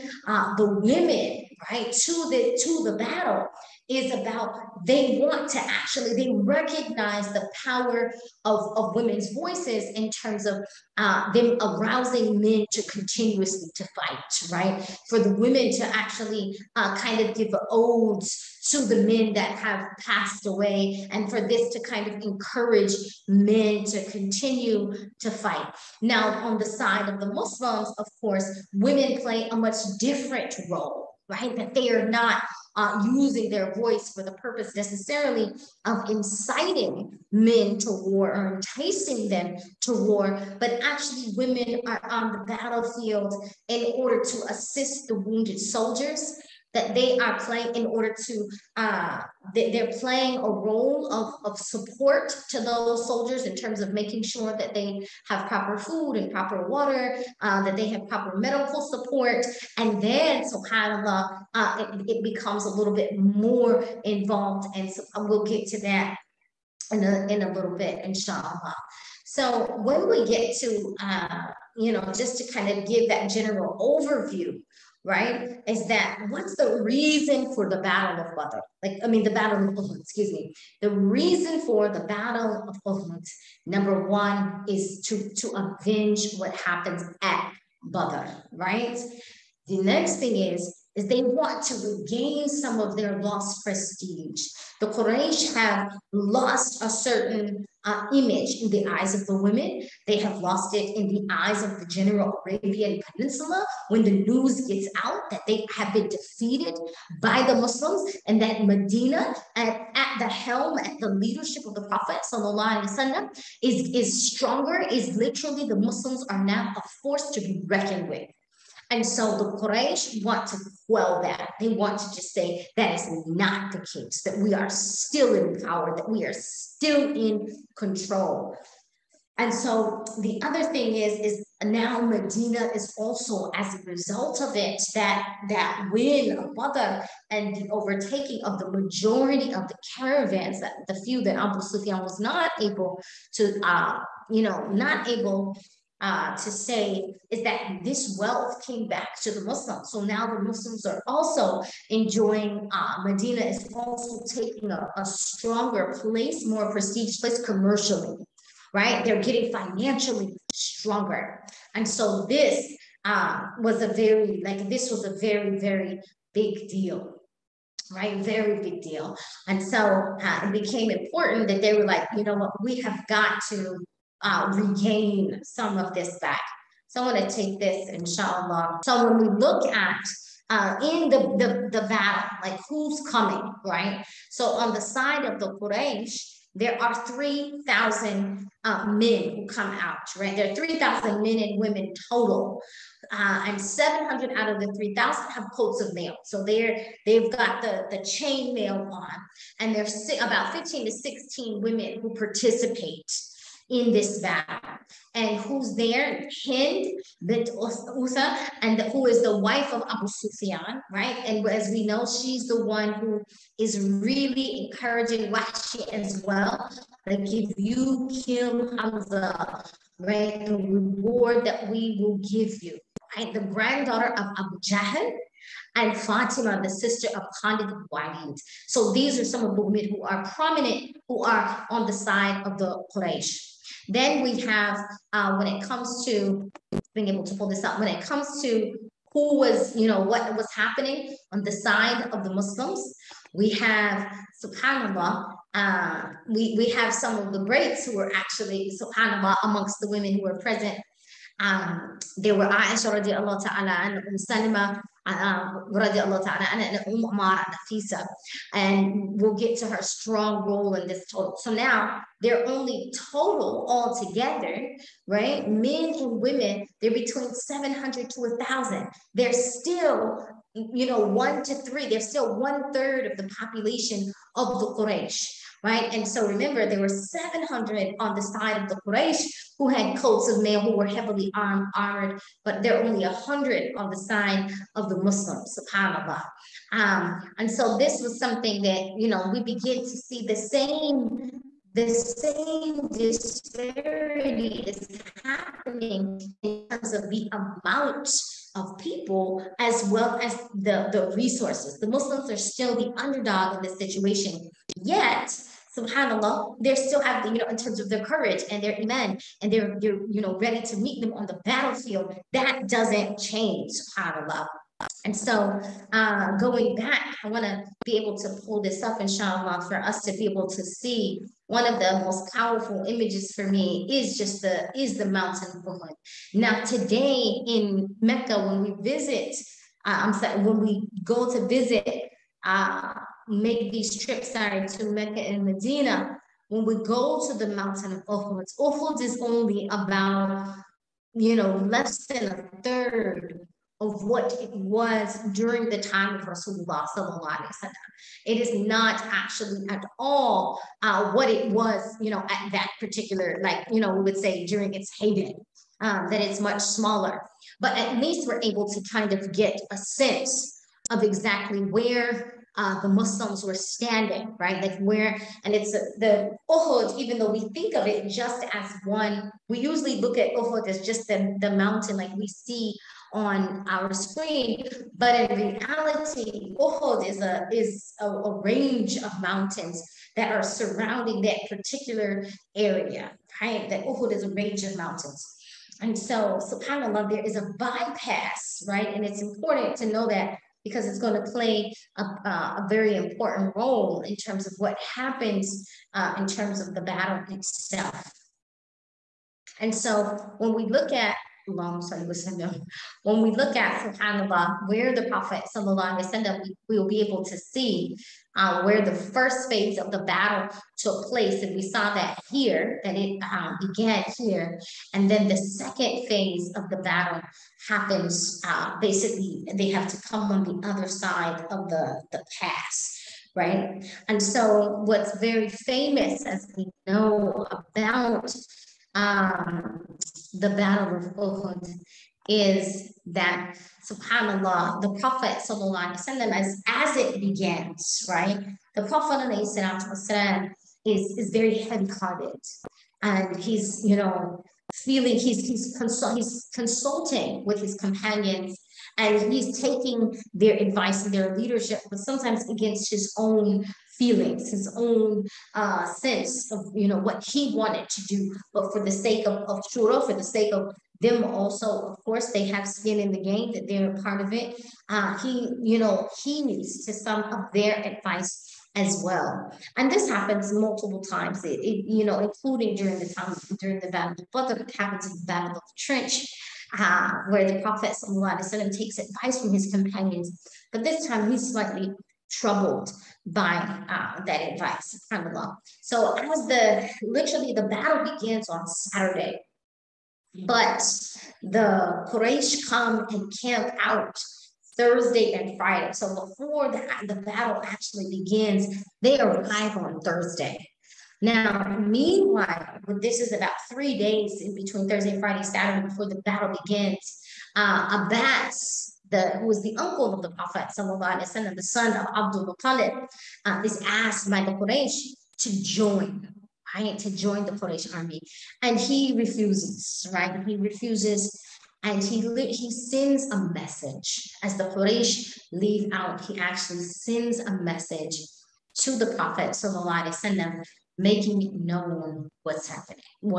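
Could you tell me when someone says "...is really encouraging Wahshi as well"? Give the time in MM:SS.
03:33.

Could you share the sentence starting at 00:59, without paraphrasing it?
And then, subhanAllah, uh, it, it becomes a little bit more involved.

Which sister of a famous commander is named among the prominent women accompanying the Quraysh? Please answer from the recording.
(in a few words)
Fatima.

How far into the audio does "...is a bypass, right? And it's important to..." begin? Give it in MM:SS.
06:27.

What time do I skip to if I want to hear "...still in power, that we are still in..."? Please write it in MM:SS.
02:04.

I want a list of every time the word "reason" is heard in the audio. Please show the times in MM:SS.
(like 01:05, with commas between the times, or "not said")
01:16, 01:20.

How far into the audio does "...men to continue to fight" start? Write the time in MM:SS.
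00:23.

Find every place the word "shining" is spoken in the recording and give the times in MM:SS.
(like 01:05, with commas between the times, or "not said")
not said.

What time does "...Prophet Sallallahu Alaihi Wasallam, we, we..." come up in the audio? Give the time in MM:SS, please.
06:45.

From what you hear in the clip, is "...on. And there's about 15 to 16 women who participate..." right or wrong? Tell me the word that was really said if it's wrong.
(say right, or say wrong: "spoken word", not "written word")
right.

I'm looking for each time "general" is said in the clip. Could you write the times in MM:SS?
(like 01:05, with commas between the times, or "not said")
01:13, 01:41.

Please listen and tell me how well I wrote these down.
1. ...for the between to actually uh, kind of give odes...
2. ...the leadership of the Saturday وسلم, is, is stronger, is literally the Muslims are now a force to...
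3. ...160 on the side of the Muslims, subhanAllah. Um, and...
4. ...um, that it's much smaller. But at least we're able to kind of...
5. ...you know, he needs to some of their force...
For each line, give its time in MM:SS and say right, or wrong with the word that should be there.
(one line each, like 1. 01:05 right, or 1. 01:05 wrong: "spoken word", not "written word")
1. 00:15 wrong: "women", not "between"
2. 01:50 wrong: "Prophet", not "Saturday"
3. 04:43 wrong: "100", not "160"
4. 05:55 right
5. 07:45 wrong: "advice", not "force".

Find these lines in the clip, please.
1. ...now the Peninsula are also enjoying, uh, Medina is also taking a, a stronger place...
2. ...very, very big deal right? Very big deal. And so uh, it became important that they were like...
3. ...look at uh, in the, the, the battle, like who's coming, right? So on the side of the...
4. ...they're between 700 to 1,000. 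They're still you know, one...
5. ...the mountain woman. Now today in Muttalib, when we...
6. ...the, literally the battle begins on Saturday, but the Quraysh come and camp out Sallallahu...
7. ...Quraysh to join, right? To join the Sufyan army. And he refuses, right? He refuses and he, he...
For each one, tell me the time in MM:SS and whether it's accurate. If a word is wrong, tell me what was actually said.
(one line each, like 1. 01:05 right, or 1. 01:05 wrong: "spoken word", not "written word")
1. 02:30 wrong: "Muslims", not "Peninsula"
2. 02:45 right
3. 02:59 right
4. 04:26 right
5. 05:24 wrong: "Mecca", not "Muttalib"
6. 08:06 wrong: "Thursday", not "Sallallahu"
7. 08:34 wrong: "Quraysh", not "Sufyan".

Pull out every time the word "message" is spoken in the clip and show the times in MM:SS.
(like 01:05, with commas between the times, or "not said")
08:43, 08:47.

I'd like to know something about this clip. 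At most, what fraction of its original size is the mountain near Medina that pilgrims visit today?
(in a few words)
a third.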